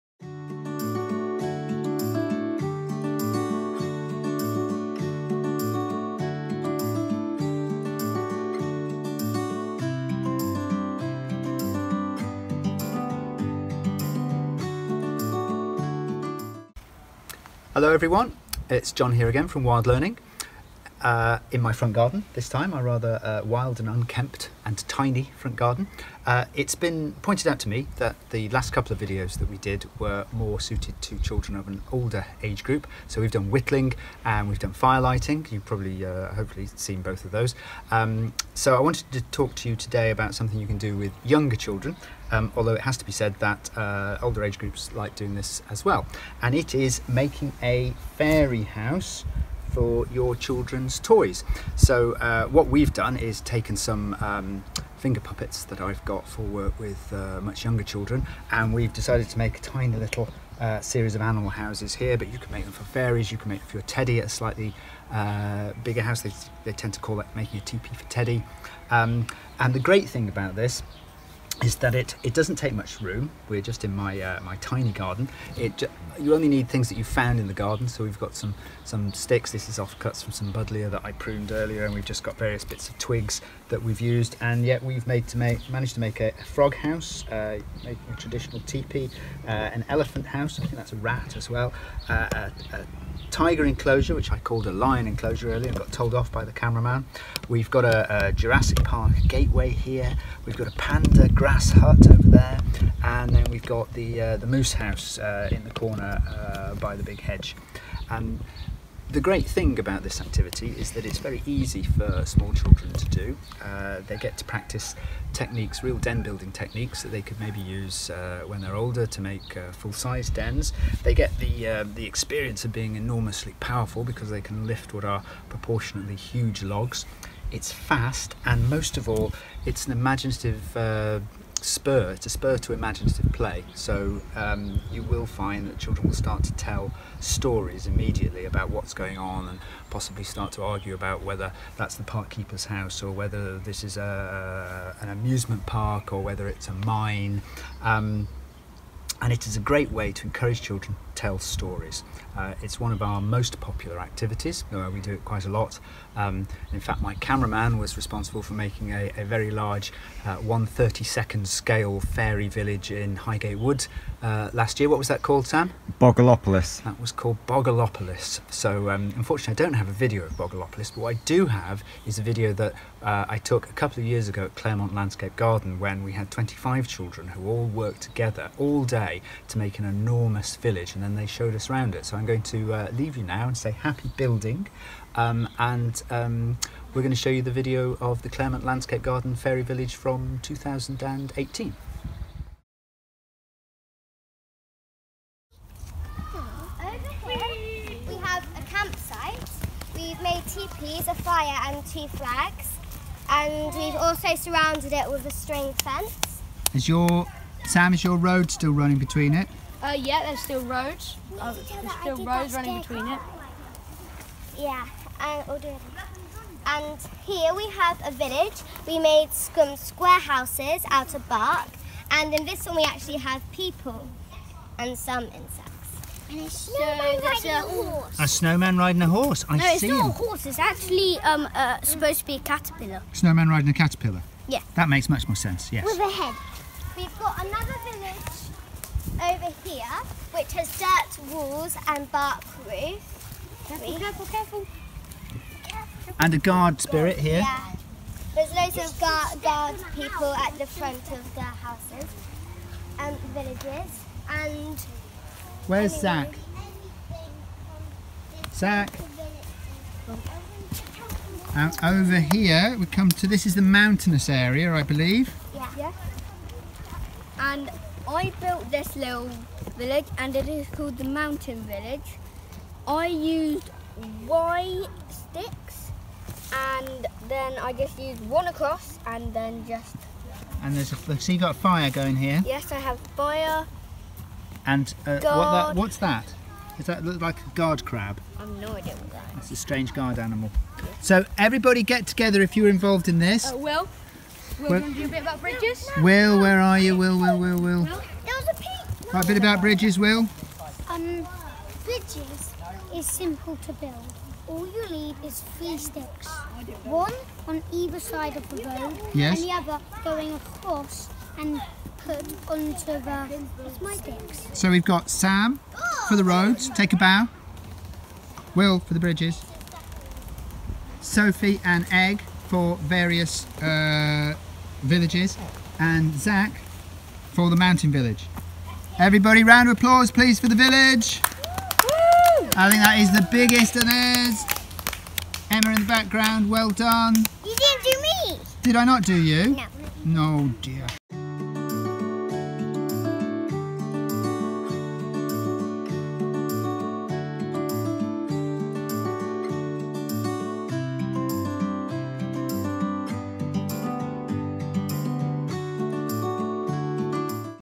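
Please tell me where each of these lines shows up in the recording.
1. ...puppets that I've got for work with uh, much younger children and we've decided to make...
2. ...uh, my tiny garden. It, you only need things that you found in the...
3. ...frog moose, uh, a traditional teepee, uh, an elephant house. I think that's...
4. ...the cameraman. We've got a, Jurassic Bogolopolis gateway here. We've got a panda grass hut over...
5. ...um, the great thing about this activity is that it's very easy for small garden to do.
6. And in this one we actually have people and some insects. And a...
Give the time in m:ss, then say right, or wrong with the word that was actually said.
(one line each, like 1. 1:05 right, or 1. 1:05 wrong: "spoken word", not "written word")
1. 0:55 right
2. 1:14 right
3. 1:26 wrong: "house", not "moose"
4. 1:36 wrong: "Park", not "Bogolopolis"
5. 1:48 wrong: "children", not "garden"
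6. 3:42 right.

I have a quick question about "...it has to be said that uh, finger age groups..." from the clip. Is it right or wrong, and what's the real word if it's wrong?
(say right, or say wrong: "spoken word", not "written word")
wrong: "older", not "finger".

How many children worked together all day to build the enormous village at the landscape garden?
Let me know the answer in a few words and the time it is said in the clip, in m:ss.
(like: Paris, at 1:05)
25, at 2:56.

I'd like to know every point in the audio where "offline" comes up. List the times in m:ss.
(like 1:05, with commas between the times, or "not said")
not said.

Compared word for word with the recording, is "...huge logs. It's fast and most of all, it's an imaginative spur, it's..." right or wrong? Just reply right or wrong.
right.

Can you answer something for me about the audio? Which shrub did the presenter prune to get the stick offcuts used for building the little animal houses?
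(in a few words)
Buddleia.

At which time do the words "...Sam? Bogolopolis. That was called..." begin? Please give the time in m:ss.
2:45.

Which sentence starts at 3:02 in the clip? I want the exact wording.
So, I'm going to uh, leave you now and say happy building.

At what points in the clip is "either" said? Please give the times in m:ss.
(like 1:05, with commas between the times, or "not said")
5:07.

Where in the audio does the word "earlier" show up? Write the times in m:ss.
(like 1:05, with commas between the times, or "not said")
1:21, 1:35.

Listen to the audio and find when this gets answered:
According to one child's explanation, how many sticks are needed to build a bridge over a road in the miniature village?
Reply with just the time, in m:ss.
5:05.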